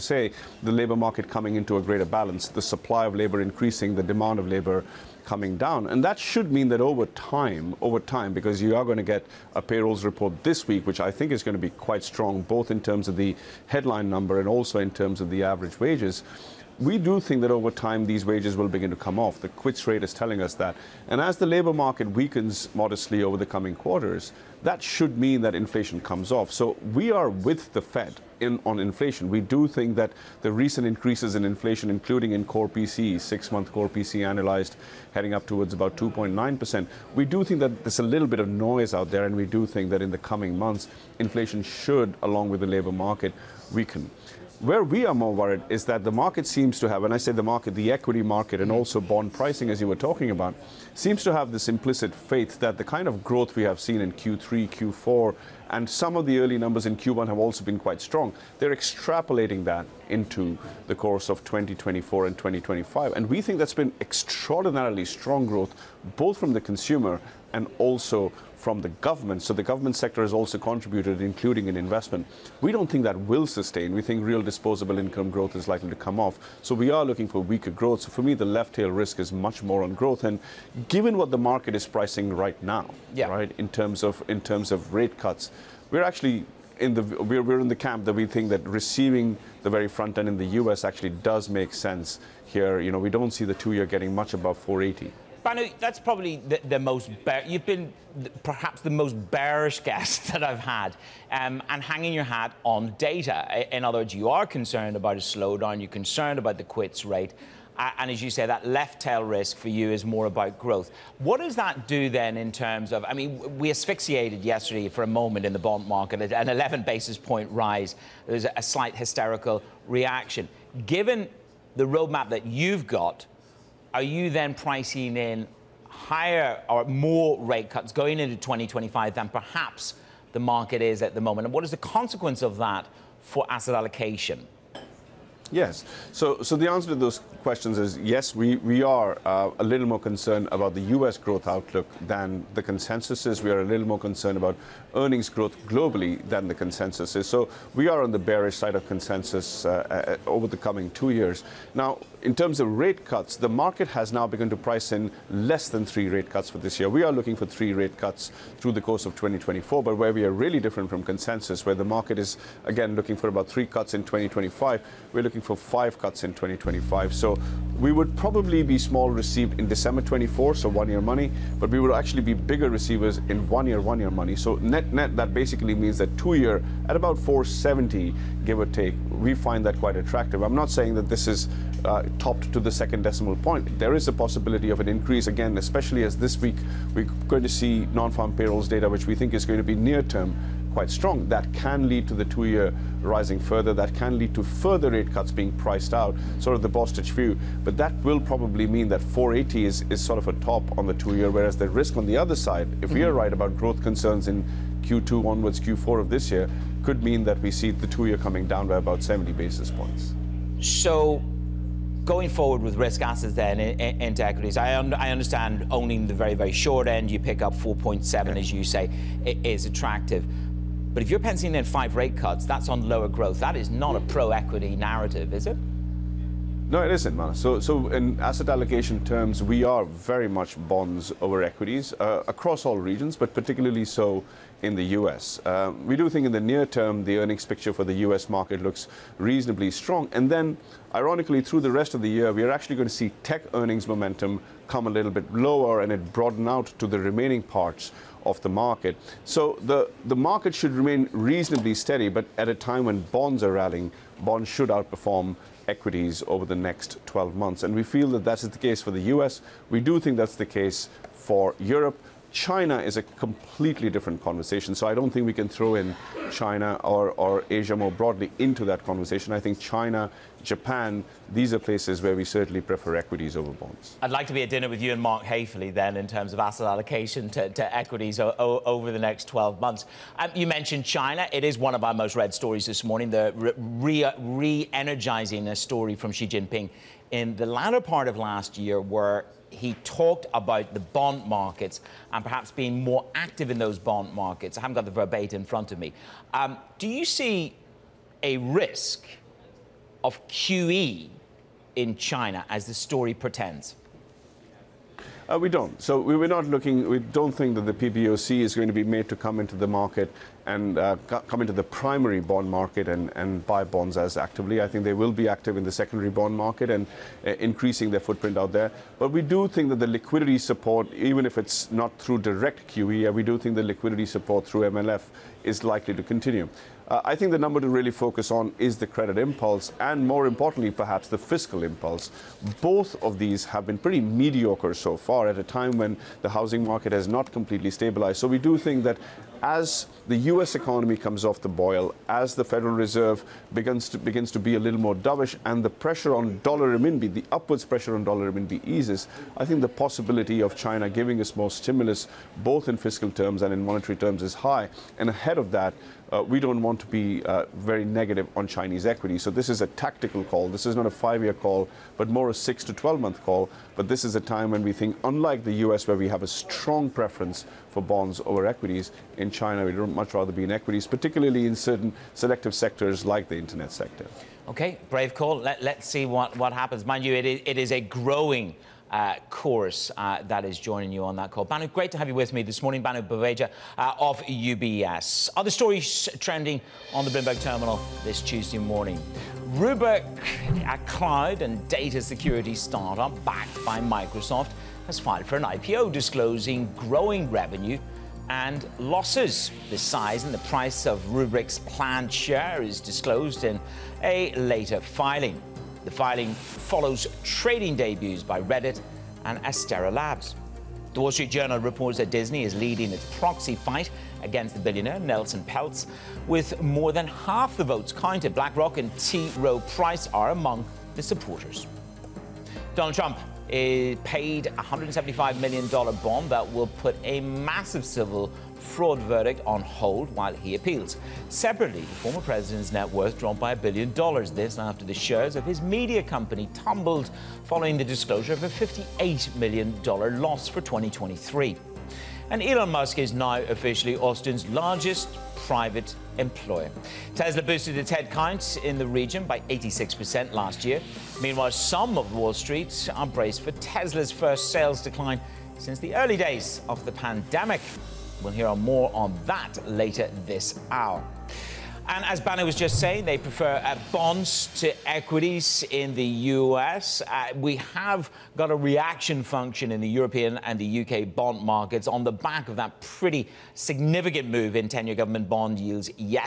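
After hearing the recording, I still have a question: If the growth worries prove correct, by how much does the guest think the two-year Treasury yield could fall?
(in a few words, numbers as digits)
70 basis points.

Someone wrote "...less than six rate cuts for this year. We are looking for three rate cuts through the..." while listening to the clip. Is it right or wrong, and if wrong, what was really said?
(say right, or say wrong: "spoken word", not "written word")
wrong: "three", not "six".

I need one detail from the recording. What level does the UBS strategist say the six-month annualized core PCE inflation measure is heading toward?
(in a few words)
2.9%.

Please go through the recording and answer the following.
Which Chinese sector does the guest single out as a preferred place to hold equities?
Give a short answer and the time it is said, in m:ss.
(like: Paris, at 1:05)
internet sector, at 6:13.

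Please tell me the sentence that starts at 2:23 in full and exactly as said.
We are a little more concerned about earnings growth globally than the consensus is.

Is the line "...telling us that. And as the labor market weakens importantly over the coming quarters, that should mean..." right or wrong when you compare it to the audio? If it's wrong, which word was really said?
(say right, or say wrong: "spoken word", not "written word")
wrong: "modestly", not "importantly".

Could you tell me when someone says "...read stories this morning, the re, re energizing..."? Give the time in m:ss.
4:42.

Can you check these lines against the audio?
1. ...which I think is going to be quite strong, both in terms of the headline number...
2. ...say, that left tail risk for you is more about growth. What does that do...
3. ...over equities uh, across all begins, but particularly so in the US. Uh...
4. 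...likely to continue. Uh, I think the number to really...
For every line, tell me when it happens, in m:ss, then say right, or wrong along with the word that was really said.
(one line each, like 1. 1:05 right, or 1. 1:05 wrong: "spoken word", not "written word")
1. 0:10 right
2. 1:48 right
3. 3:51 wrong: "regions", not "begins"
4. 5:25 right.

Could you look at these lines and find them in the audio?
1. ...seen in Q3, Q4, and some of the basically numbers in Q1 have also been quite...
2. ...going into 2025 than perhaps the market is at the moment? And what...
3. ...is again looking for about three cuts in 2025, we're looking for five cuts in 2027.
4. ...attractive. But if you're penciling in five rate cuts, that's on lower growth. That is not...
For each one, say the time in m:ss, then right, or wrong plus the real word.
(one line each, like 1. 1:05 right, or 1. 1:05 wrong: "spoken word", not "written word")
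1. 0:53 wrong: "early", not "basically"
2. 2:07 right
3. 2:42 wrong: "2025", not "2027"
4. 3:39 right.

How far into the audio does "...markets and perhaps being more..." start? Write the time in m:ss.
4:51.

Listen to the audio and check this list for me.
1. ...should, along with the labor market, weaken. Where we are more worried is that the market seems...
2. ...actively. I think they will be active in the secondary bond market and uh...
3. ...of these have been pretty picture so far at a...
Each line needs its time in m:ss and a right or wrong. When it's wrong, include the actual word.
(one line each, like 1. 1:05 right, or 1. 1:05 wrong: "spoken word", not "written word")
1. 0:41 right
2. 5:14 right
3. 5:33 wrong: "mediocre", not "picture".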